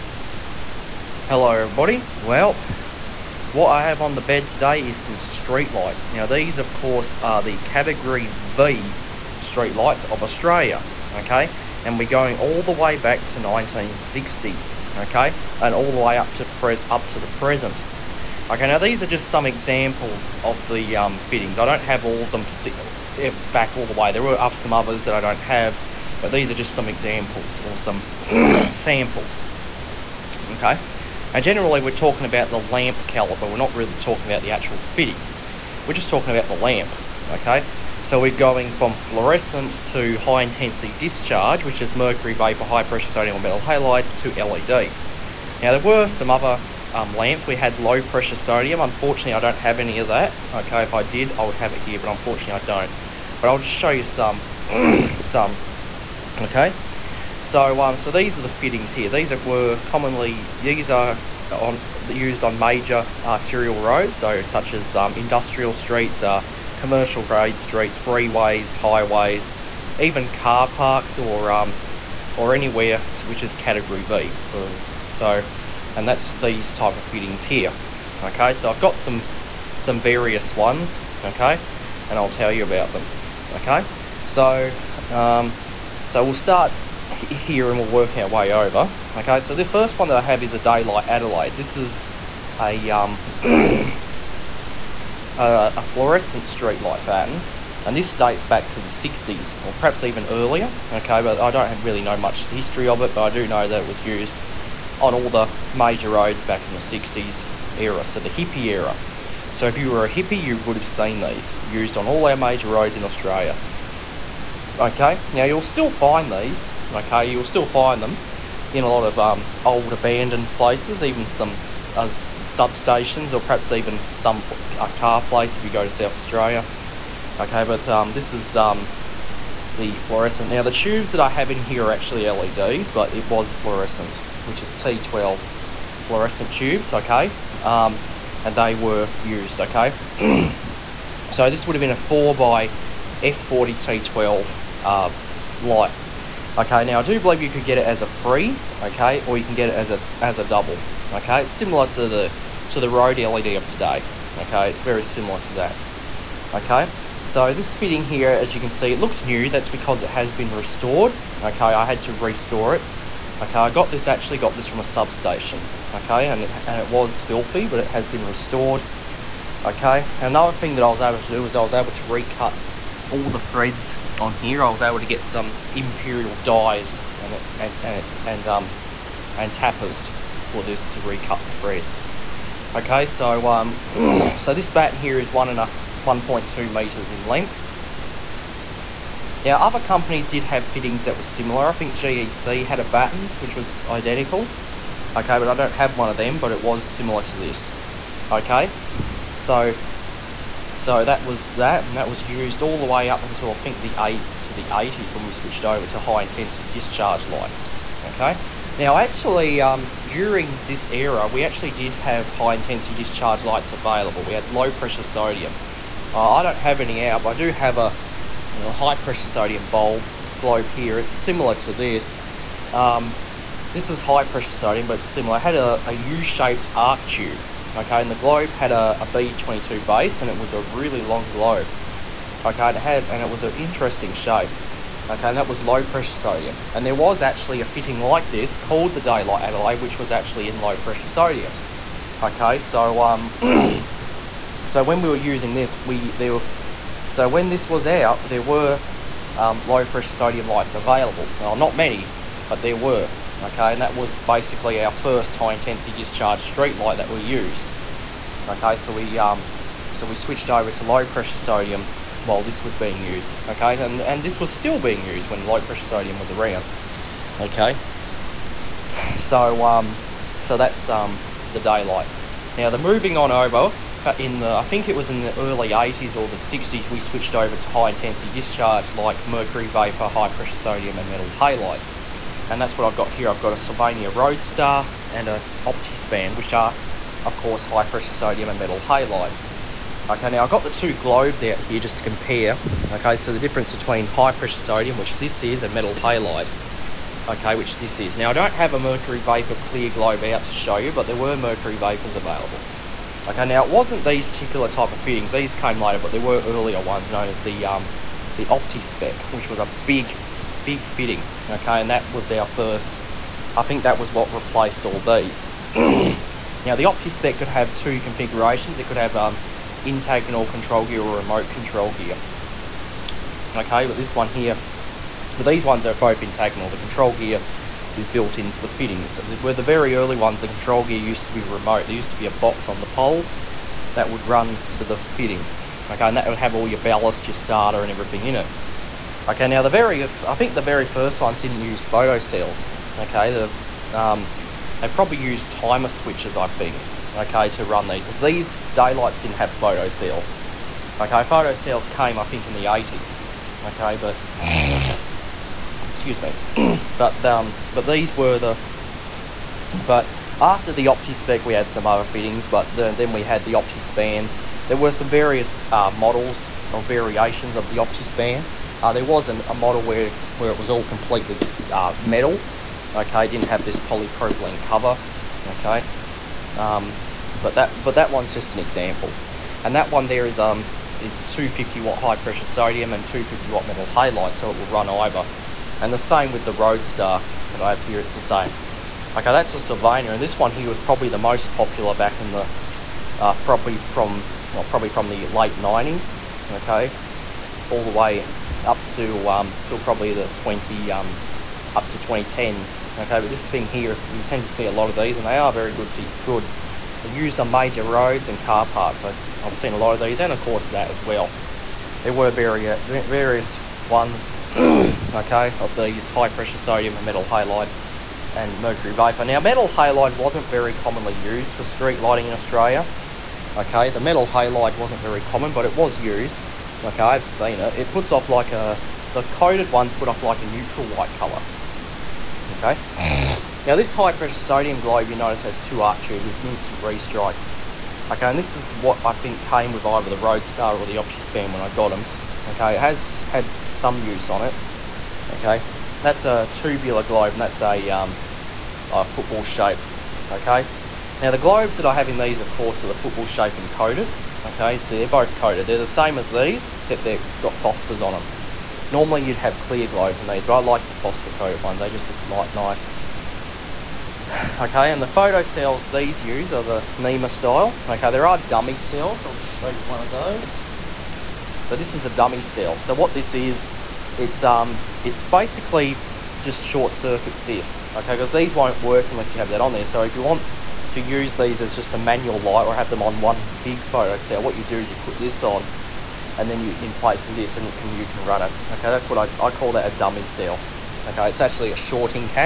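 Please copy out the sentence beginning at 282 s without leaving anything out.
And that's what I've got here.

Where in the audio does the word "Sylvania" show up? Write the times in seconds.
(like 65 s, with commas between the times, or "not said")
283 s, 389 s.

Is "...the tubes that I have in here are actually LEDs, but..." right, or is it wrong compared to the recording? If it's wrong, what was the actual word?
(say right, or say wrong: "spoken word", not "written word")
right.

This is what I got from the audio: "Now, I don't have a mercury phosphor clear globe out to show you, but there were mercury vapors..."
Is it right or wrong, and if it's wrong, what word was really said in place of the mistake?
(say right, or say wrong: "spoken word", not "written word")
wrong: "vapor", not "phosphor".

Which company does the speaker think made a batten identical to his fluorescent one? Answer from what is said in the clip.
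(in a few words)
GEC.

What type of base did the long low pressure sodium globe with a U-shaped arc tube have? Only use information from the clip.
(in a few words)
B22.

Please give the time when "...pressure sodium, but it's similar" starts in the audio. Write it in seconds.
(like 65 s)
224 s.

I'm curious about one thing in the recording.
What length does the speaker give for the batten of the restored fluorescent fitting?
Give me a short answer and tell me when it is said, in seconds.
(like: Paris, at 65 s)
1.2 meters, at 186 s.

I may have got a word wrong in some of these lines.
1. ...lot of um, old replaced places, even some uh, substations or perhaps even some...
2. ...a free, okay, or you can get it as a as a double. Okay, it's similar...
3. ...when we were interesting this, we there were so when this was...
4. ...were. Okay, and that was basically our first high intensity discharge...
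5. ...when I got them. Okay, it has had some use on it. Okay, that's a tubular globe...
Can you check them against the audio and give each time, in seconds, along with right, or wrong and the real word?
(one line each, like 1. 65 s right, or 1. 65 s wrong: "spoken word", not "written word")
1. 118 s wrong: "abandoned", not "replaced"
2. 148 s right
3. 244 s wrong: "using", not "interesting"
4. 252 s right
5. 441 s right.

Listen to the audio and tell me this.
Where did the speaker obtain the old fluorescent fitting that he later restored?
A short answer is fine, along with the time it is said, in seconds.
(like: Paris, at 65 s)
A substation, at 164 s.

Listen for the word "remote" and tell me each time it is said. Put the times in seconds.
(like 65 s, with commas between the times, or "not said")
321 s, 331 s.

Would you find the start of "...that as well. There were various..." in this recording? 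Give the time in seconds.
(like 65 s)
410 s.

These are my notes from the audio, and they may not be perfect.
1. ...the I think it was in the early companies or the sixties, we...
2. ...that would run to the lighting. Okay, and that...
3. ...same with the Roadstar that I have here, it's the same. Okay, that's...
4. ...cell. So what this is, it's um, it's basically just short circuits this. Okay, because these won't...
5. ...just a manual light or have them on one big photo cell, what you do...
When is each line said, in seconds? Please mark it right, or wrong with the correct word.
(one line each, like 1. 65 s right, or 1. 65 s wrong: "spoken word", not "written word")
1. 274 s wrong: "eighties", not "companies"
2. 333 s wrong: "fitting", not "lighting"
3. 385 s right
4. 472 s right
5. 481 s right.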